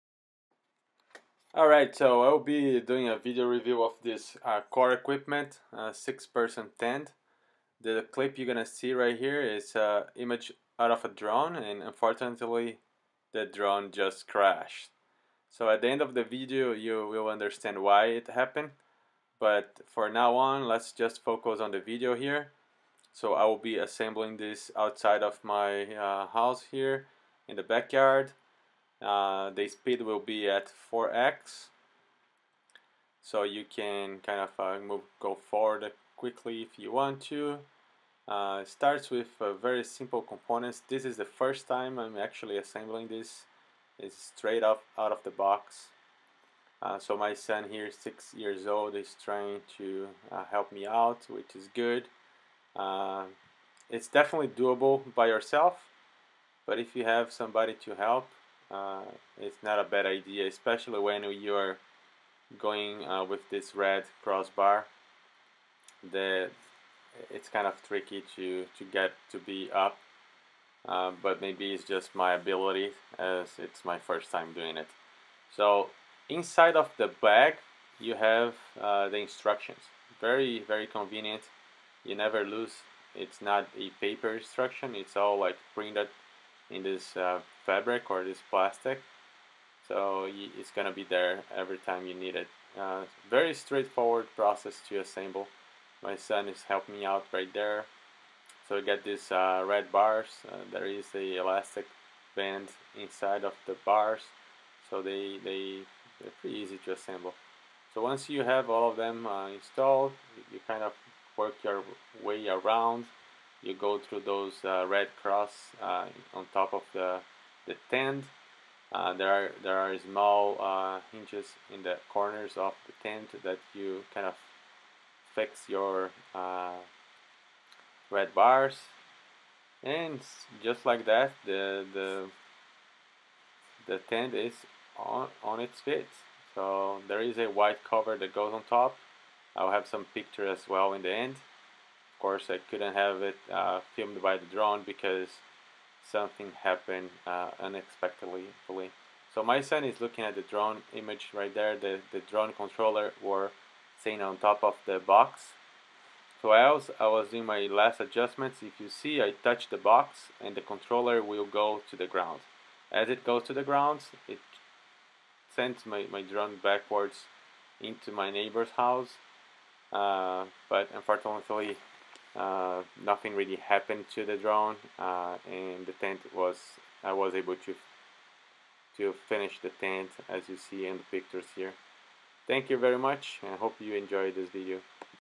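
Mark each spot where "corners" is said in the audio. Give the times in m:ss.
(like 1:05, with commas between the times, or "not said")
2:02.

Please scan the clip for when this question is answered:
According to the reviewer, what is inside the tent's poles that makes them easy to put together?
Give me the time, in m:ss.
1:41.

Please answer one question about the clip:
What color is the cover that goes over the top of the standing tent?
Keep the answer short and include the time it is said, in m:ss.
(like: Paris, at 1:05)
white, at 2:17.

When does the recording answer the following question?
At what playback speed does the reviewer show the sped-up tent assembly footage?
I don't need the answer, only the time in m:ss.
0:30.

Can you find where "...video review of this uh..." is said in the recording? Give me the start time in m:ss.
0:03.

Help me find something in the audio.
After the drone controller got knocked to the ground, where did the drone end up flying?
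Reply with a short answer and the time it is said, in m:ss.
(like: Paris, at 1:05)
neighbor's house, at 2:48.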